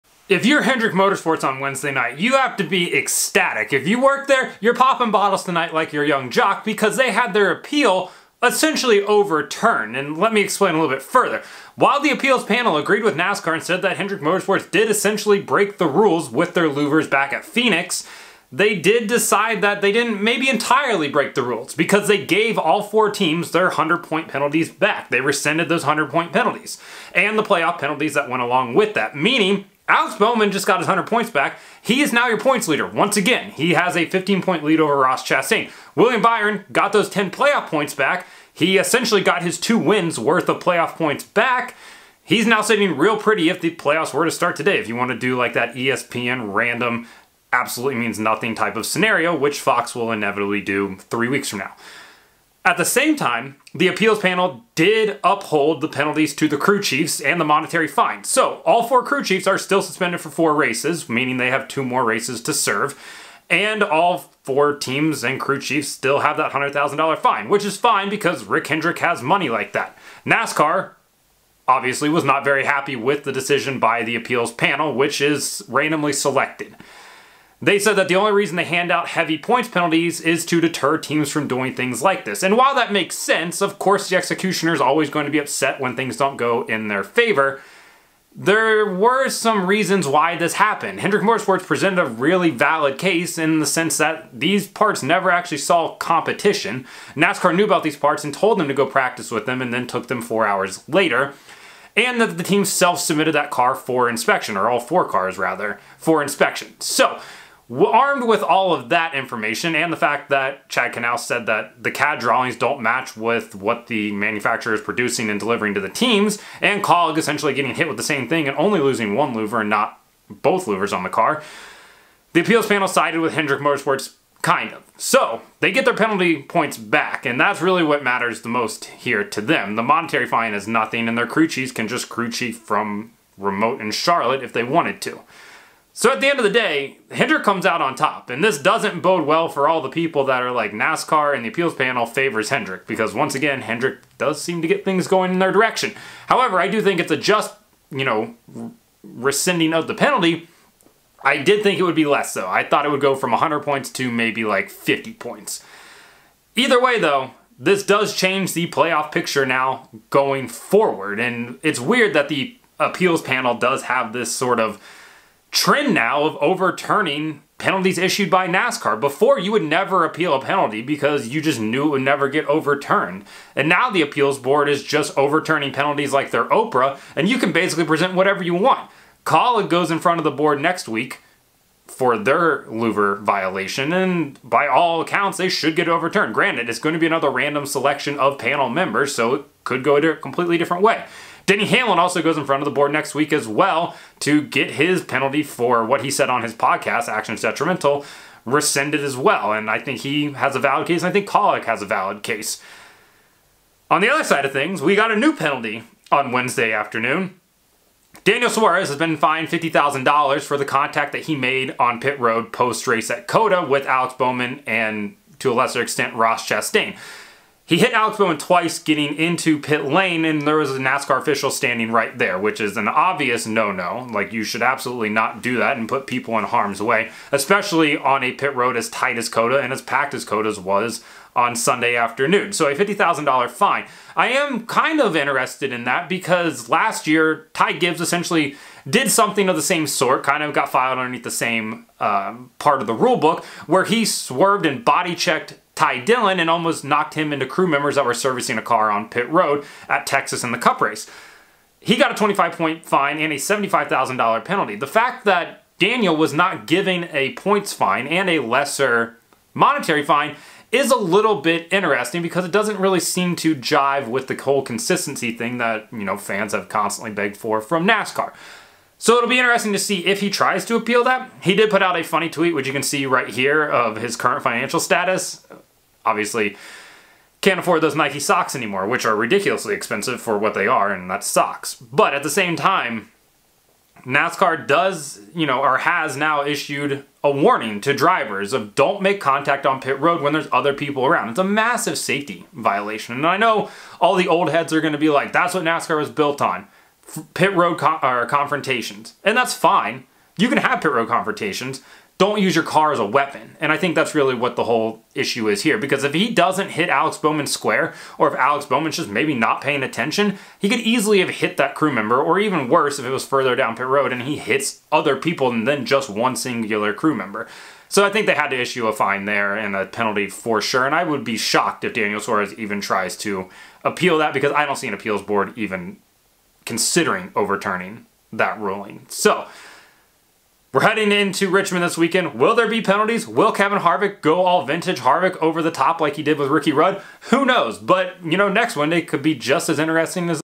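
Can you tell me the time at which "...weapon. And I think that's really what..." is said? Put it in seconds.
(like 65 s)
303 s.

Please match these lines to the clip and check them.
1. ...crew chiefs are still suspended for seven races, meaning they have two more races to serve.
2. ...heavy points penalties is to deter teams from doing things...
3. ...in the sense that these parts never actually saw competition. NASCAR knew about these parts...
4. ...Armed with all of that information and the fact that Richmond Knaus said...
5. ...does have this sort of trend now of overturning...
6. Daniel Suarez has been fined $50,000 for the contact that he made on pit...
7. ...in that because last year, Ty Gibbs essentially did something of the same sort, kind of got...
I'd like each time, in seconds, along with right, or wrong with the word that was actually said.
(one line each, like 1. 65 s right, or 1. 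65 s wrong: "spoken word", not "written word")
1. 59 s wrong: "four", not "seven"
2. 79 s right
3. 93 s right
4. 107 s wrong: "Chad", not "Richmond"
5. 163 s right
6. 208 s right
7. 235 s right.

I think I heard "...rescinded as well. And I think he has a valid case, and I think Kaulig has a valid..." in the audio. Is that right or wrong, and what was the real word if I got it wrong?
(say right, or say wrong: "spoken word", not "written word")
right.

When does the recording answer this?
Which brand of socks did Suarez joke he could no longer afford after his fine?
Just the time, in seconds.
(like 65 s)
277 s.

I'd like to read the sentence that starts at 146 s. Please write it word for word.
However, I do think it's a just, you know, rescinding of the penalty.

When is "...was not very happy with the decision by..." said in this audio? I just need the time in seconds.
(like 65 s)
72 s.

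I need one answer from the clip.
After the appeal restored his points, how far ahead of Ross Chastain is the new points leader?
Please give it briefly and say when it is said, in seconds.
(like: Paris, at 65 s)
15, at 34 s.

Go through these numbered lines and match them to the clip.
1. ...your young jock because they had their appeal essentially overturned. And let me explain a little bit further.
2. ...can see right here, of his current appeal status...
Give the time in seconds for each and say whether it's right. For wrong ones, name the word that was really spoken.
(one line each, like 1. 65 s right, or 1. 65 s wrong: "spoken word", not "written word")
1. 5 s right
2. 272 s wrong: "financial", not "appeal".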